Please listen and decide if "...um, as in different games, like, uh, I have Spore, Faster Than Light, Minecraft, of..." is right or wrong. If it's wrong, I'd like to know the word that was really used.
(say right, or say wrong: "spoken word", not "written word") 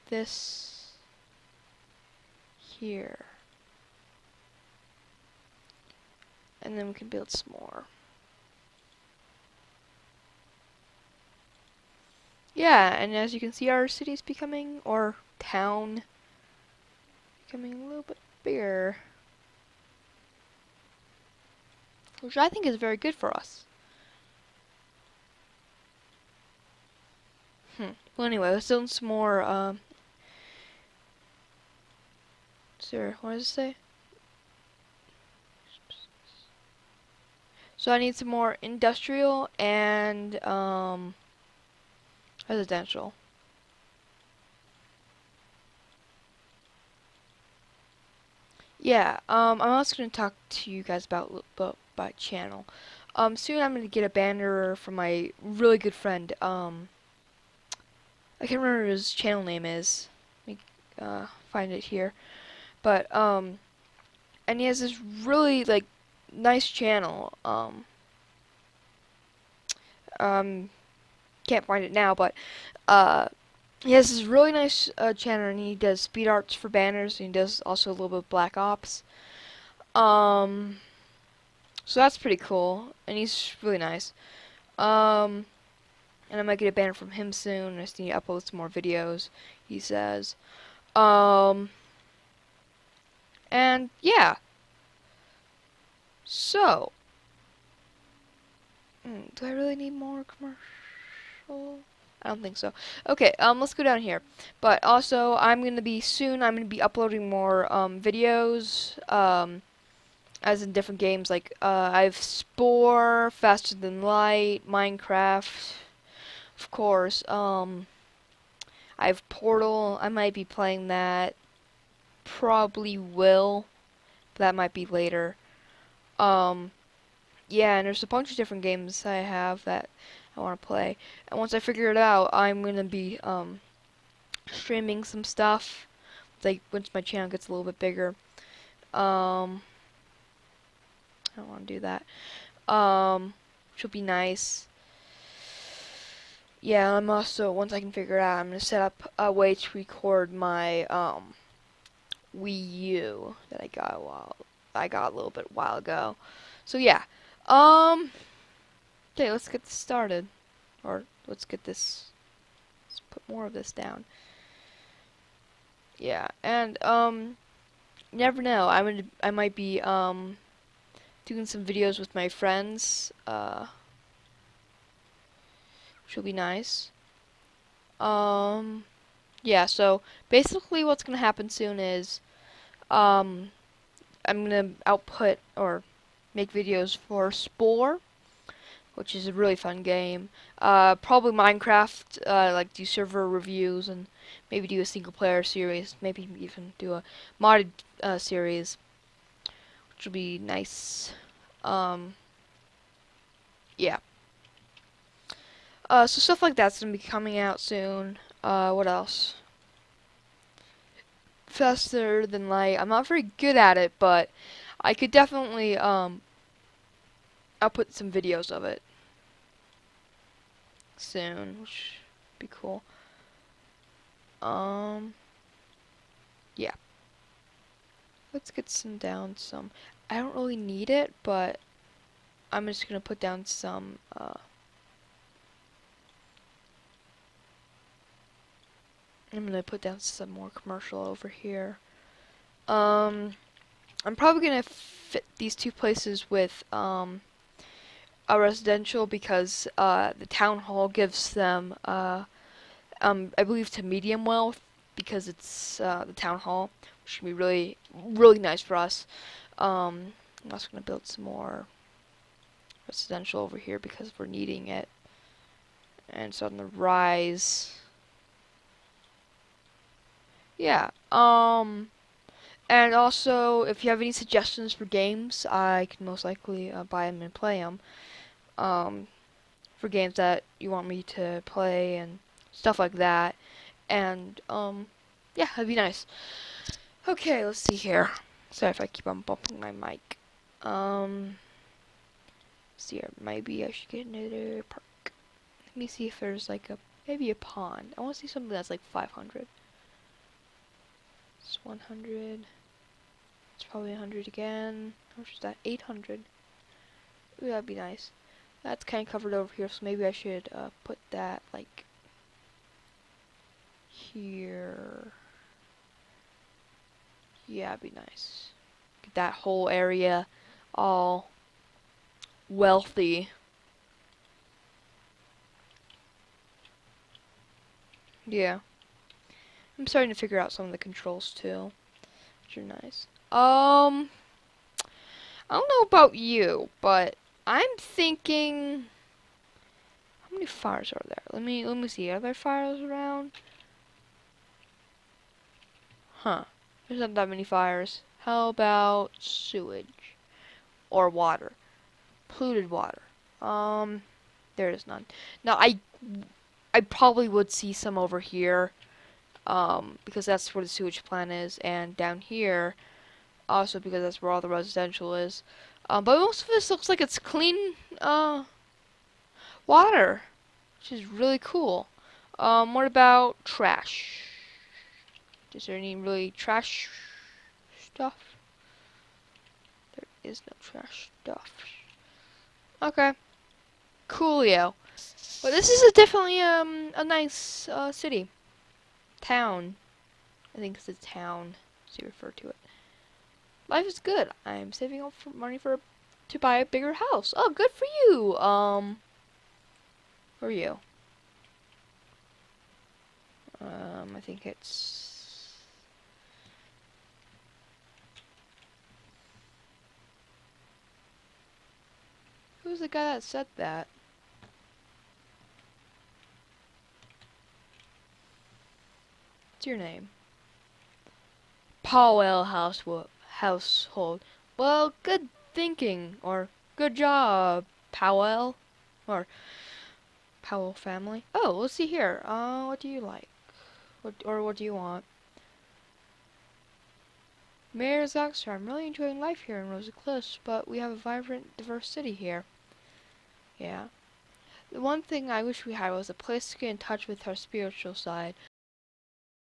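right.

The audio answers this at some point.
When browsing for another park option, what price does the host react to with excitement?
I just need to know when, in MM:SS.
05:05.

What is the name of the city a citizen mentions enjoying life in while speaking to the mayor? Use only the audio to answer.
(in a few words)
Rosa Cliffs.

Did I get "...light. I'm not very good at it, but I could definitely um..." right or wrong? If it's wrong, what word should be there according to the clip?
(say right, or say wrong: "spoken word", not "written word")
right.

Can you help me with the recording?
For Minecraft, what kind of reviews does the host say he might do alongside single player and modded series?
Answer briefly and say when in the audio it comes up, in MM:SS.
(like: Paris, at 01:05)
server reviews, at 03:12.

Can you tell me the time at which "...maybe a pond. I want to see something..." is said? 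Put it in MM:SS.
04:57.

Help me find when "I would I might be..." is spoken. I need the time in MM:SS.
02:48.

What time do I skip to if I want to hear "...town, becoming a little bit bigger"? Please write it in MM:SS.
00:15.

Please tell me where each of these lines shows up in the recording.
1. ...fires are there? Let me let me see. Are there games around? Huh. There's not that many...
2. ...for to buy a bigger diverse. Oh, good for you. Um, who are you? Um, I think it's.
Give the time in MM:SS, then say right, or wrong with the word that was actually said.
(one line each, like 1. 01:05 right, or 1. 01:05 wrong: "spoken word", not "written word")
1. 05:40 wrong: "fires", not "games"
2. 06:35 wrong: "house", not "diverse".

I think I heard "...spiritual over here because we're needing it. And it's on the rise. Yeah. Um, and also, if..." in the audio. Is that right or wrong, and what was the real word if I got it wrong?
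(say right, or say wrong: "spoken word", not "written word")
wrong: "residential", not "spiritual".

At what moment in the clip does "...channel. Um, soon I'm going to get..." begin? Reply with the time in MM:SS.
00:52.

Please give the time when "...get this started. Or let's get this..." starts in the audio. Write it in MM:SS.
02:39.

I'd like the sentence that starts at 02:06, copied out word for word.
Um, yeah, and there's a bunch of different games I have that I want to play.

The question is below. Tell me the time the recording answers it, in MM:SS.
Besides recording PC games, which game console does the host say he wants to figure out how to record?
02:32.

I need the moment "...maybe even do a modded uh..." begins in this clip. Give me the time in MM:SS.
03:16.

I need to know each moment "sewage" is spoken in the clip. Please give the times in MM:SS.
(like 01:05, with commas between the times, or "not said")
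05:49, 06:00.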